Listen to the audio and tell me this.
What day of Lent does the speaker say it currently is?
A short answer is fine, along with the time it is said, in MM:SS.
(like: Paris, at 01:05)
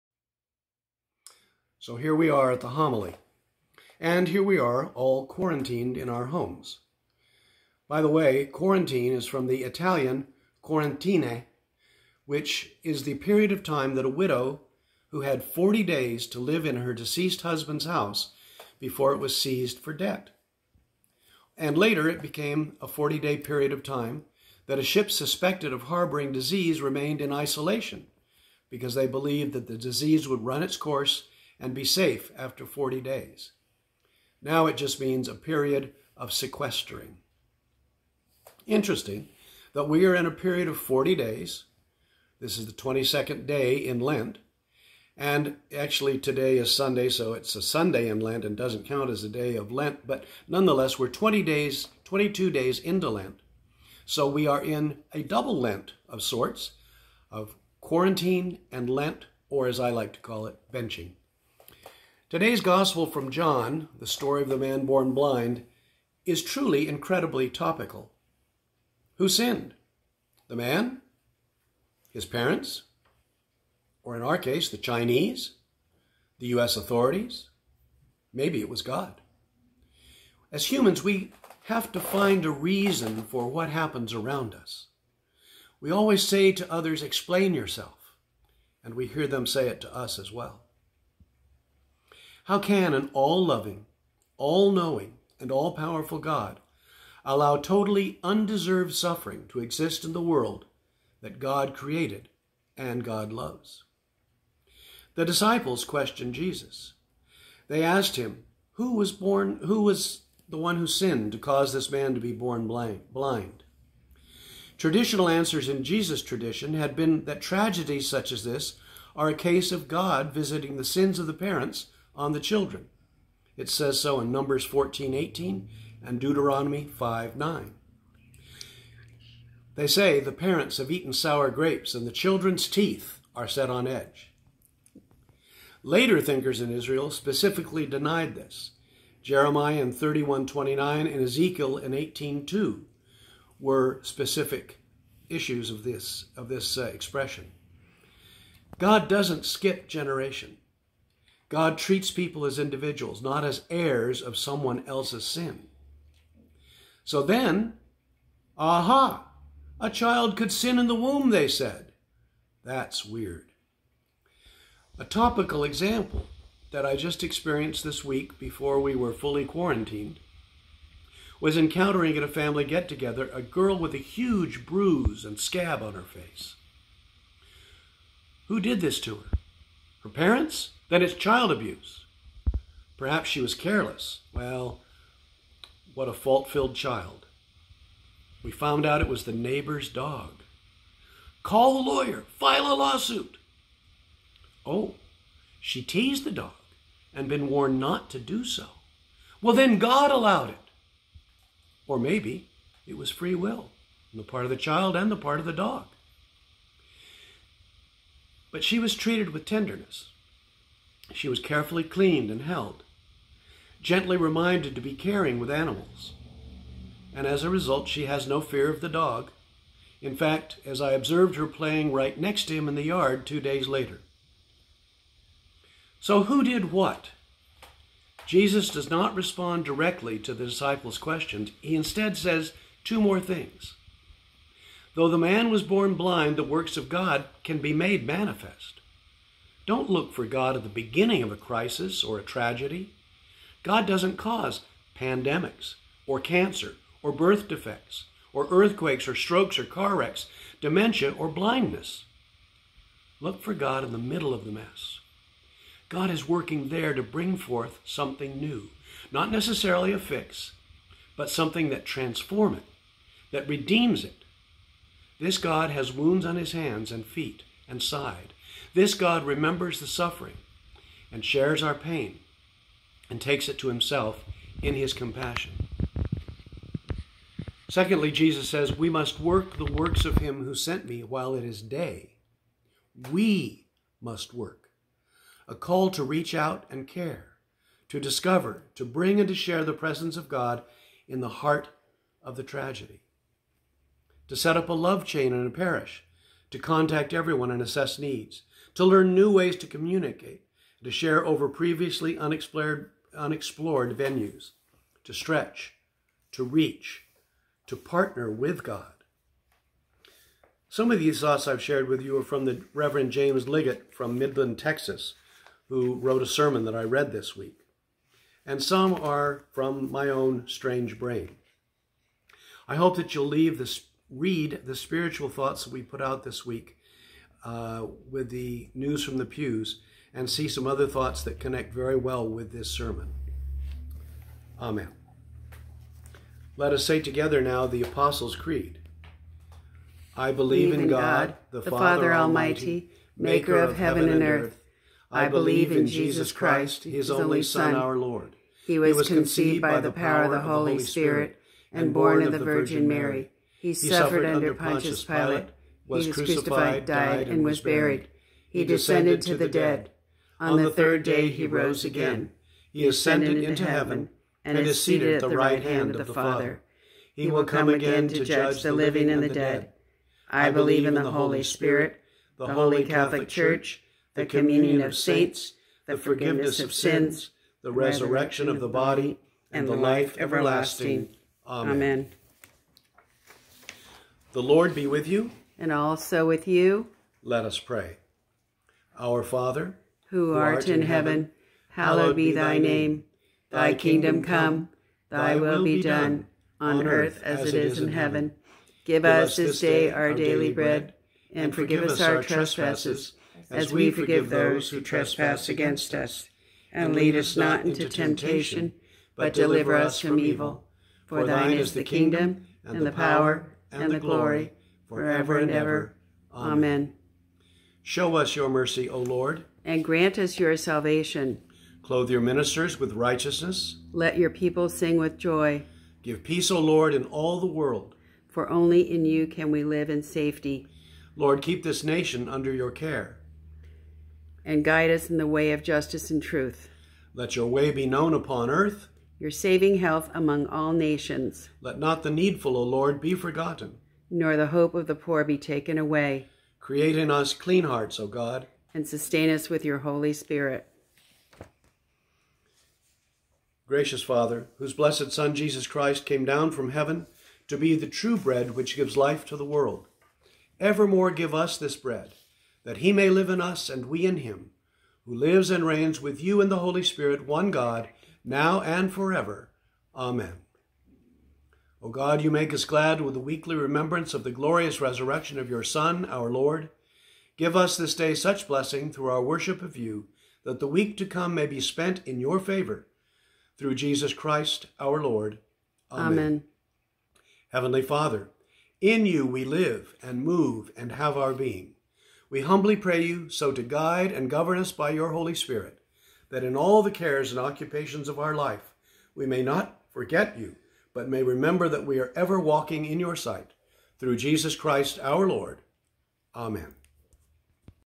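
22nd, at 00:42.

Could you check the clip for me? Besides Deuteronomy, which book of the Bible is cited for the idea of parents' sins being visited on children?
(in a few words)
Numbers.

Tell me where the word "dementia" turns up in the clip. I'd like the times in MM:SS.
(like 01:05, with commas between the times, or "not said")
04:10.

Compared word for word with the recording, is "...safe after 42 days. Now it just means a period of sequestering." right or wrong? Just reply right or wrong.
wrong.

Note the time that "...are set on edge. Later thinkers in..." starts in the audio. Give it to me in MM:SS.
02:13.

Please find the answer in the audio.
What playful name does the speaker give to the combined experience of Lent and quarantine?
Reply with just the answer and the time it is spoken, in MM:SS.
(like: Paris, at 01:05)
benching, at 01:00.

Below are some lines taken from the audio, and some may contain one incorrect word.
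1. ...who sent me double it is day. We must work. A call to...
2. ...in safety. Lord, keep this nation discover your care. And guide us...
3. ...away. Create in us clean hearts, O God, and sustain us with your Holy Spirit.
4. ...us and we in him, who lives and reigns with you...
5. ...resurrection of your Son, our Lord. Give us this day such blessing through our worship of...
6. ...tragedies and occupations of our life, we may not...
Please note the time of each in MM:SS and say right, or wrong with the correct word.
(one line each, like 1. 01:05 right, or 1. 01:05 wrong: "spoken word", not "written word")
1. 04:40 wrong: "while", not "double"
2. 07:09 wrong: "under", not "discover"
3. 07:25 right
4. 07:43 right
5. 07:54 right
6. 08:16 wrong: "cares", not "tragedies".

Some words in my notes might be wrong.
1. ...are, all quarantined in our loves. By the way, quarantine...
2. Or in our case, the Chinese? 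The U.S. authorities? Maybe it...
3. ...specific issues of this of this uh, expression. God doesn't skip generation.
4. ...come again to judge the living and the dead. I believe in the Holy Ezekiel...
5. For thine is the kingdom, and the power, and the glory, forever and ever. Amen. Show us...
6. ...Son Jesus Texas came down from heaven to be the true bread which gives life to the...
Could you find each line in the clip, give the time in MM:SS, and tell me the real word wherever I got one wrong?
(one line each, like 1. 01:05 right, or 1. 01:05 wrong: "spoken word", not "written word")
1. 00:04 wrong: "homes", not "loves"
2. 01:14 right
3. 02:24 right
4. 06:07 wrong: "Spirit", not "Ezekiel"
5. 06:51 right
6. 07:35 wrong: "Christ", not "Texas".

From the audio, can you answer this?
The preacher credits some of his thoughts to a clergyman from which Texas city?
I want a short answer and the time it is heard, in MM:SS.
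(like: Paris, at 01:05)
Midland, at 05:14.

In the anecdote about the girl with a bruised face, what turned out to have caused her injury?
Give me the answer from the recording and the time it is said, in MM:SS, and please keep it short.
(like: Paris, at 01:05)
The neighbor's dog, at 03:09.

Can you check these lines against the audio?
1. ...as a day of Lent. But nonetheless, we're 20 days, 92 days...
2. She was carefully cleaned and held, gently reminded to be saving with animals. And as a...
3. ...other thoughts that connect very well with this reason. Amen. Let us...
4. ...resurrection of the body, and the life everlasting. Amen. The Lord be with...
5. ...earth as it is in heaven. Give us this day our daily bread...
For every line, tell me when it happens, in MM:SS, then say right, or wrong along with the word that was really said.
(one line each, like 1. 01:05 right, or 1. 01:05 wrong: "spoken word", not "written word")
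1. 00:49 wrong: "22", not "92"
2. 03:31 wrong: "caring", not "saving"
3. 05:30 wrong: "sermon", not "reason"
4. 06:17 right
5. 06:36 right.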